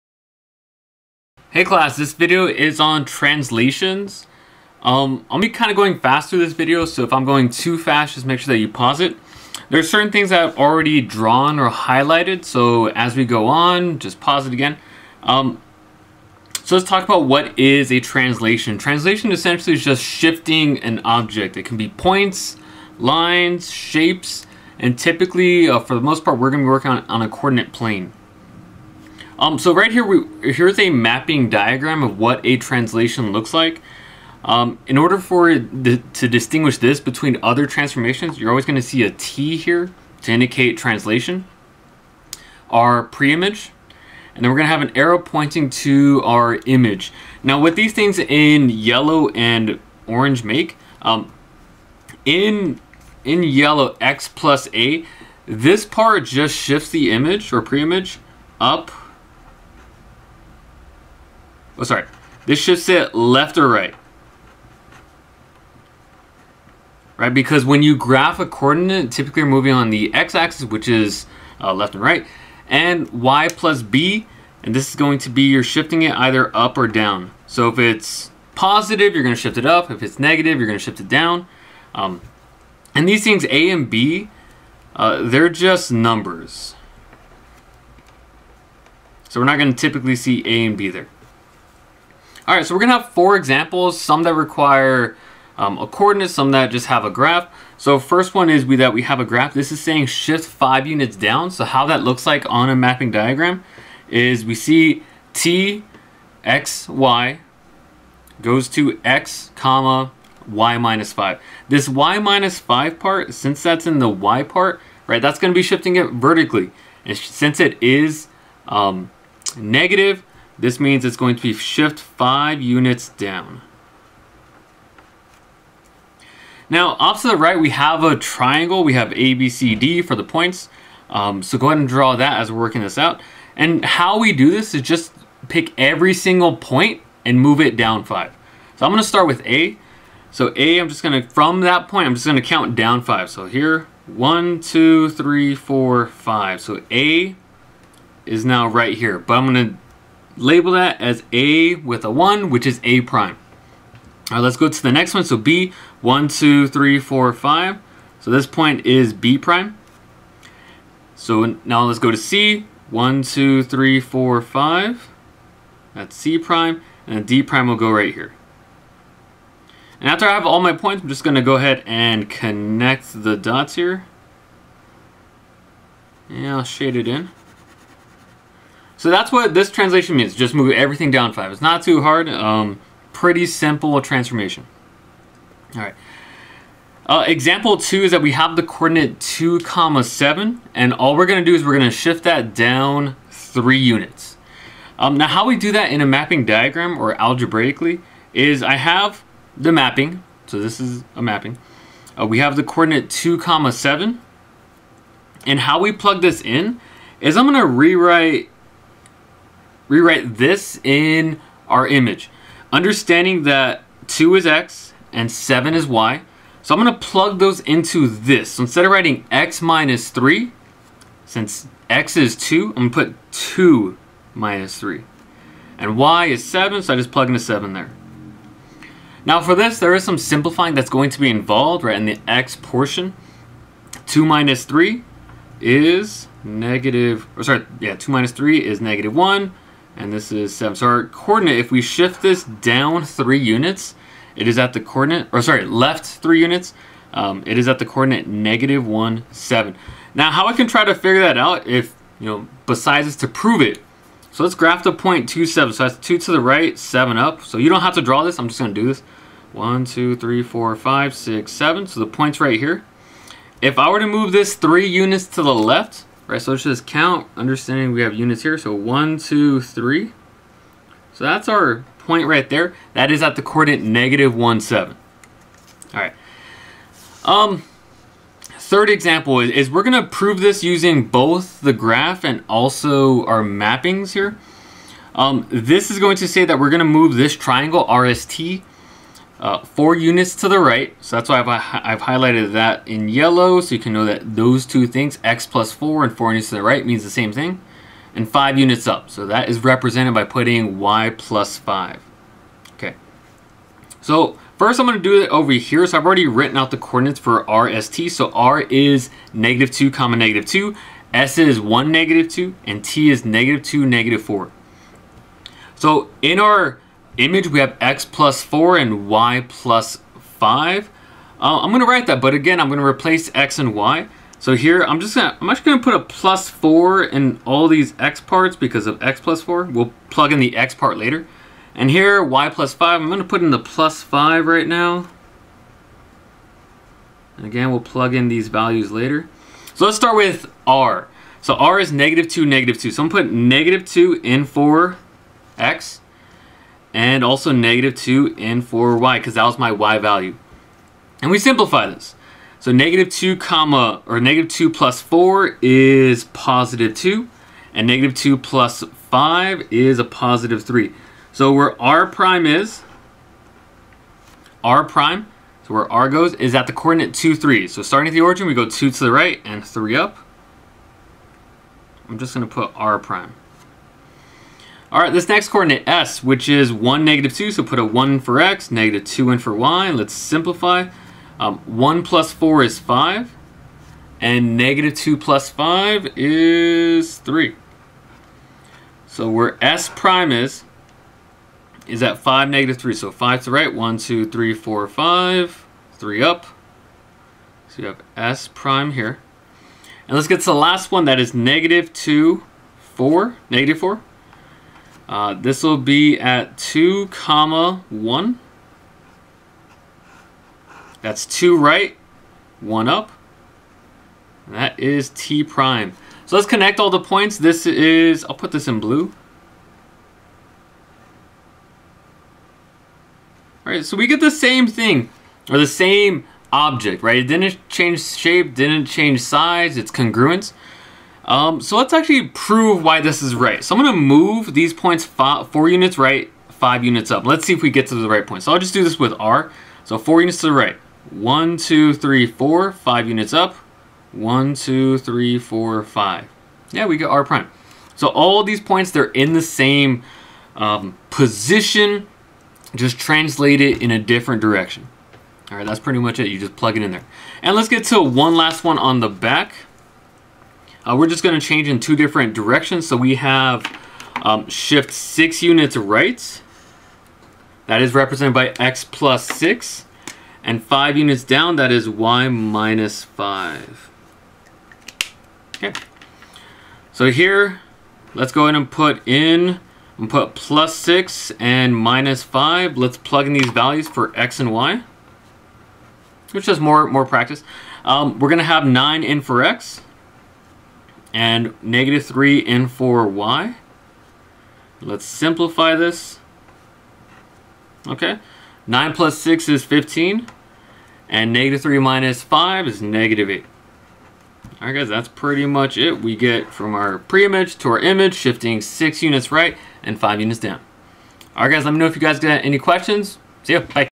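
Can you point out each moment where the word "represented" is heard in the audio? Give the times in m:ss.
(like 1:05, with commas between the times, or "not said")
4:59, 7:47.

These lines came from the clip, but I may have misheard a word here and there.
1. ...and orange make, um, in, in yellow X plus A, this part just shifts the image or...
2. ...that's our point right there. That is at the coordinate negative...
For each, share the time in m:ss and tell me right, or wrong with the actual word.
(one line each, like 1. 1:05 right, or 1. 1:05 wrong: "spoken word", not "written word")
1. 0:49 right
2. 4:31 right.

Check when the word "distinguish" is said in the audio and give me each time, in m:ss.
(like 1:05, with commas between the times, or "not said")
0:36.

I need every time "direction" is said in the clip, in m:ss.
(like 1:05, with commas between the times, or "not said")
7:34, 7:42.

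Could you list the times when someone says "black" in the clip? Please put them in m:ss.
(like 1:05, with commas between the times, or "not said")
not said.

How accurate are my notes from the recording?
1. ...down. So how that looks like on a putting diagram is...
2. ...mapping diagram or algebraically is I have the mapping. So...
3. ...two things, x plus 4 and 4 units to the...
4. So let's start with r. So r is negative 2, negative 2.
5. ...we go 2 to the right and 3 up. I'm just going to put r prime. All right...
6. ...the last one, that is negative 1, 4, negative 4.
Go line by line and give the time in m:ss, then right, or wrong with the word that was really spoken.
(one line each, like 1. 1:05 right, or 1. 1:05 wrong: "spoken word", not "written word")
1. 1:41 wrong: "mapping", not "putting"
2. 3:16 right
3. 4:54 right
4. 5:39 right
5. 6:08 right
6. 6:40 wrong: "2", not "1".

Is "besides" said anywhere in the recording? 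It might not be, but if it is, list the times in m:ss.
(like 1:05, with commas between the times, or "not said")
4:12.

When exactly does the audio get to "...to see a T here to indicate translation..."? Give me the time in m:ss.
0:38.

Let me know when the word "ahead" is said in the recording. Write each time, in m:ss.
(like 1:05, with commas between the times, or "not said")
2:11, 2:51, 7:58.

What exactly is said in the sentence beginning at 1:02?
This should sit left or right.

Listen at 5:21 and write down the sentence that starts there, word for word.
Uh, I'm going to write that, but again, I'm going to replace x and y.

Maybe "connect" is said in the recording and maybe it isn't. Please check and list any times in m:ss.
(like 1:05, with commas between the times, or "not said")
2:52, 6:56.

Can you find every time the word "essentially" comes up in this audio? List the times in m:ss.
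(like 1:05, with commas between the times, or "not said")
0:19.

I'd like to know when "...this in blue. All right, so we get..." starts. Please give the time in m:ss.
6:58.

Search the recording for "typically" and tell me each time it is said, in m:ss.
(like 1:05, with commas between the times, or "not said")
0:24, 1:09, 1:29.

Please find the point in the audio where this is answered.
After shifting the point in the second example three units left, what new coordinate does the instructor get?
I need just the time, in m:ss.
4:08.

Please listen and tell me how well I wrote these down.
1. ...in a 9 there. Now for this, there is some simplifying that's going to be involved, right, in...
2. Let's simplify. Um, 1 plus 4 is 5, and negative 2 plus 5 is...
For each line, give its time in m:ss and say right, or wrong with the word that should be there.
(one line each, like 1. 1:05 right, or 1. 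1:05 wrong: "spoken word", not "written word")
1. 3:47 wrong: "7", not "9"
2. 6:19 right.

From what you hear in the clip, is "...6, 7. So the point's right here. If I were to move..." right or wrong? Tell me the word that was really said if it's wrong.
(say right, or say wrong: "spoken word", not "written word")
right.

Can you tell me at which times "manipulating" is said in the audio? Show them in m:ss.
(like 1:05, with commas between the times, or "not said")
not said.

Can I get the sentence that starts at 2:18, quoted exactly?
So I'm gonna start with A.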